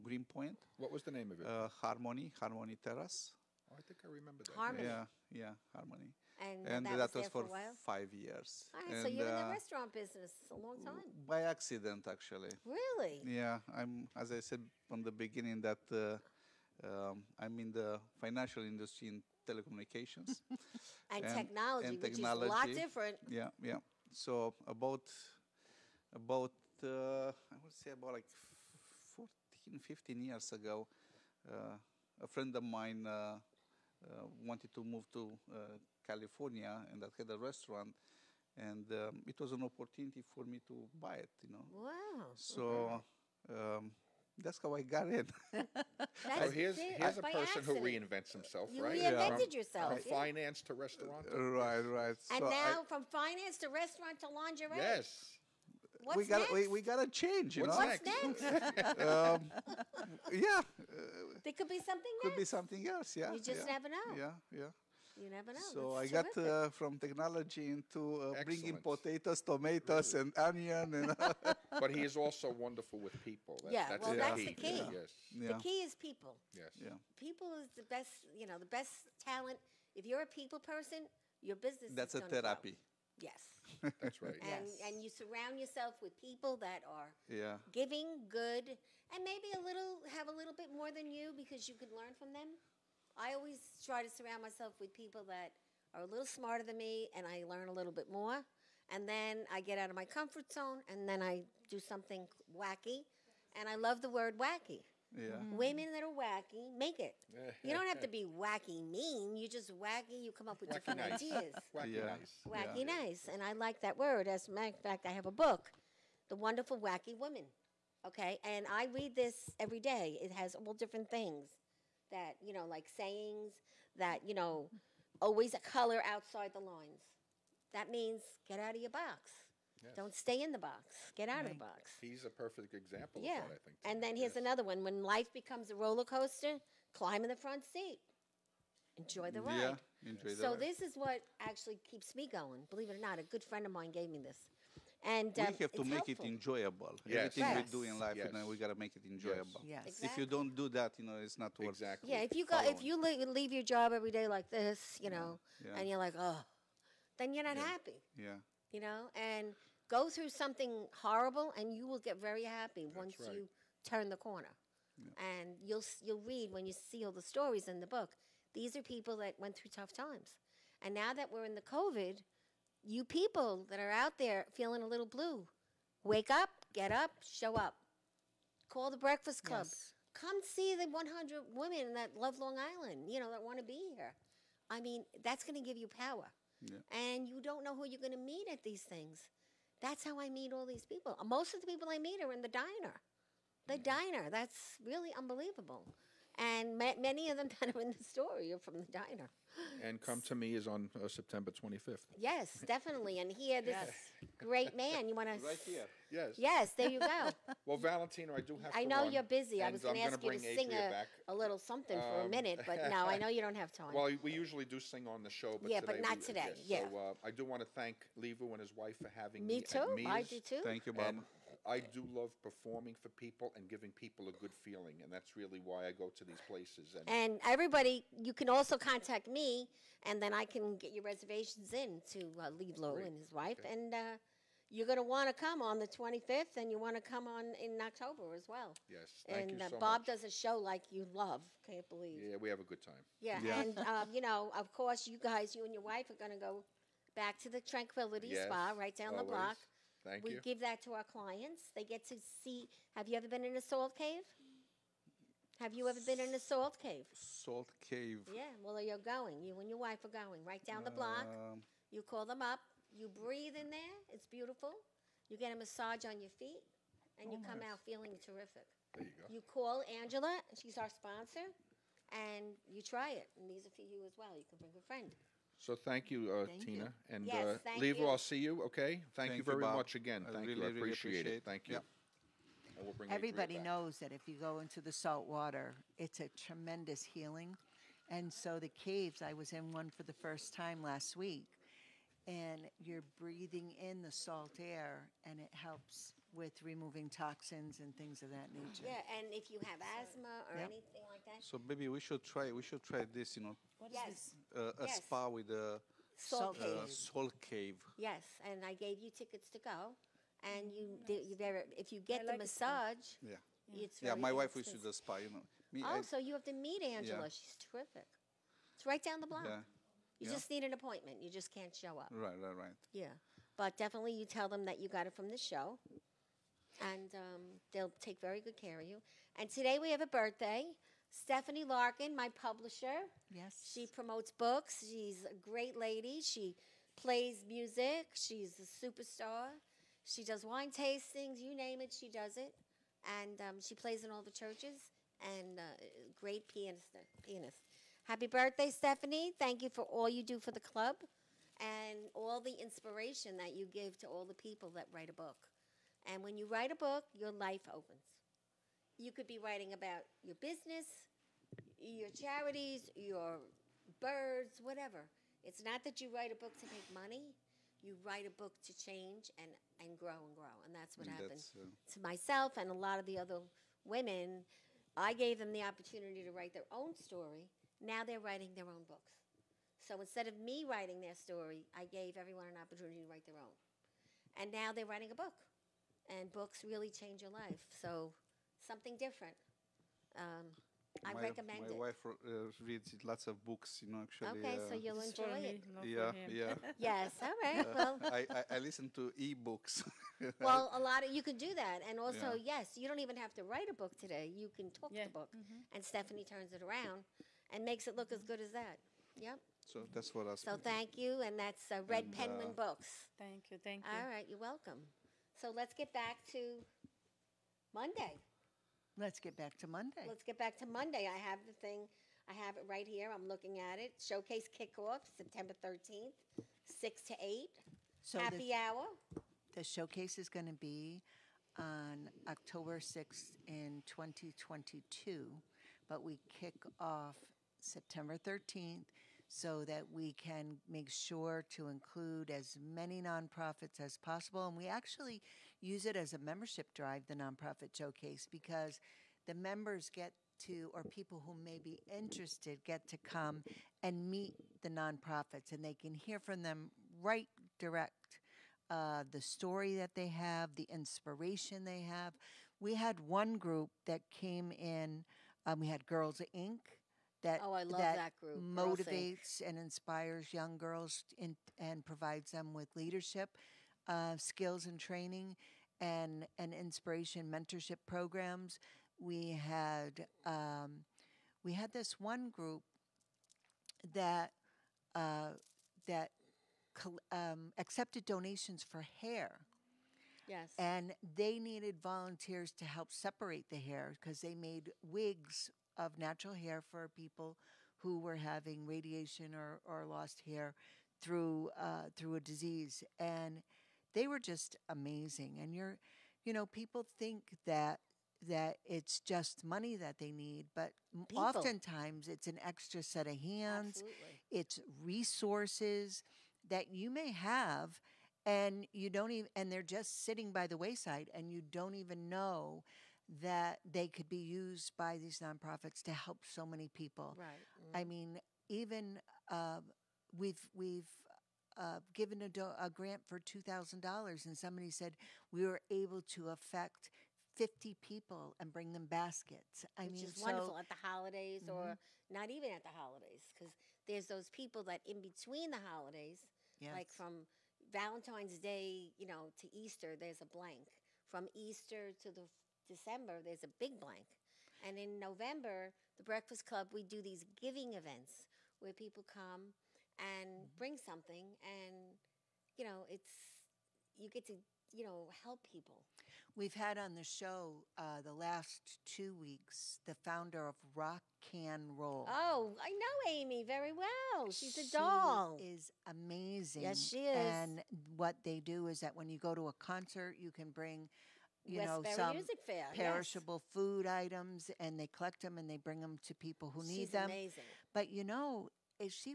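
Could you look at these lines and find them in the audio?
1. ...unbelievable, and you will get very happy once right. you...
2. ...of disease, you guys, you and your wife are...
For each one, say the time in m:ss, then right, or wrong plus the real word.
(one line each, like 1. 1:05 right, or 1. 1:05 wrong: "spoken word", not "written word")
1. 2:41 wrong: "horrible", not "unbelievable"
2. 4:04 wrong: "course", not "disease".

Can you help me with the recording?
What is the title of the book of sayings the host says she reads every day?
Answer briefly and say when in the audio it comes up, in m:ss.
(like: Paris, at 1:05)
The Wonderful Wacky Woman, at 1:56.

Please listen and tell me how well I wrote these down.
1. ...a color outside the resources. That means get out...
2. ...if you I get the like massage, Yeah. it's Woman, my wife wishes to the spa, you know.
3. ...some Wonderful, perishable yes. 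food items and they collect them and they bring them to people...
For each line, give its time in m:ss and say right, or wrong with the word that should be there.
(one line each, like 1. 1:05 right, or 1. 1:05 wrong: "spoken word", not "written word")
1. 2:05 wrong: "lines", not "resources"
2. 5:11 wrong: "Yeah", not "Woman"
3. 9:41 wrong: "Fair", not "Wonderful".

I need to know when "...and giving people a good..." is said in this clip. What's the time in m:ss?
3:43.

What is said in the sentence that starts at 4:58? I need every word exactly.
Yeah, and if you have asthma or anything so maybe we should try, we should try this, you know, What is this?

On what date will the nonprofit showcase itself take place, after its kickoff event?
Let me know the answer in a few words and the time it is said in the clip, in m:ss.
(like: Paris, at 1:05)
October 6th, 2022, at 7:12.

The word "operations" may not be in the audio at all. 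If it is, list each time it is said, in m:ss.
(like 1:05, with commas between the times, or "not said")
not said.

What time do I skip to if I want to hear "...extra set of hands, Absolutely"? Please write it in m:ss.
8:32.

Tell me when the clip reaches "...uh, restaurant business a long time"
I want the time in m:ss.
0:09.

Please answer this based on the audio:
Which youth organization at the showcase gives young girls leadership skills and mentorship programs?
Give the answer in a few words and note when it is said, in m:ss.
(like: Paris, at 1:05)
Girls Inc., at 7:45.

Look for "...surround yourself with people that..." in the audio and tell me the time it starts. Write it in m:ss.
1:25.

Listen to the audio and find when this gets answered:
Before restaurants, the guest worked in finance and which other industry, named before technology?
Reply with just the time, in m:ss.
0:19.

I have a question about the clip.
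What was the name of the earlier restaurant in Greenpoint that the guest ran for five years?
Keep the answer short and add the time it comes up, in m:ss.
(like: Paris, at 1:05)
Harmony Terrace, at 0:02.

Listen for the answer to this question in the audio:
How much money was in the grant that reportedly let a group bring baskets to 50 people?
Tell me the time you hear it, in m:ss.
8:53.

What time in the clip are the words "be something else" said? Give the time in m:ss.
1:02.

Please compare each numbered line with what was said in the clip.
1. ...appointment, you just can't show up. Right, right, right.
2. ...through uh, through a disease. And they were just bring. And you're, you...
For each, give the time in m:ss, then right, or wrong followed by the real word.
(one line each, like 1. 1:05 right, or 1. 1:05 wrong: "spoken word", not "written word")
1. 5:20 right
2. 8:20 wrong: "amazing", not "bring".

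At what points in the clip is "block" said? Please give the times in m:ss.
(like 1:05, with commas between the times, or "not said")
4:09, 4:20, 5:19.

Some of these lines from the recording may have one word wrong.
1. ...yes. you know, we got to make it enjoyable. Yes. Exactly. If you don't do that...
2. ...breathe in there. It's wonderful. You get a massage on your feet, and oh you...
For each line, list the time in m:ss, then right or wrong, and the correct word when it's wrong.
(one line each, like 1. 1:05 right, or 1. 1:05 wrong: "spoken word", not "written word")
1. 2:28 right
2. 4:23 wrong: "beautiful", not "wonderful".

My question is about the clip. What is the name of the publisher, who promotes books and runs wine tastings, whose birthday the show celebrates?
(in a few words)
Stephanie Larkin.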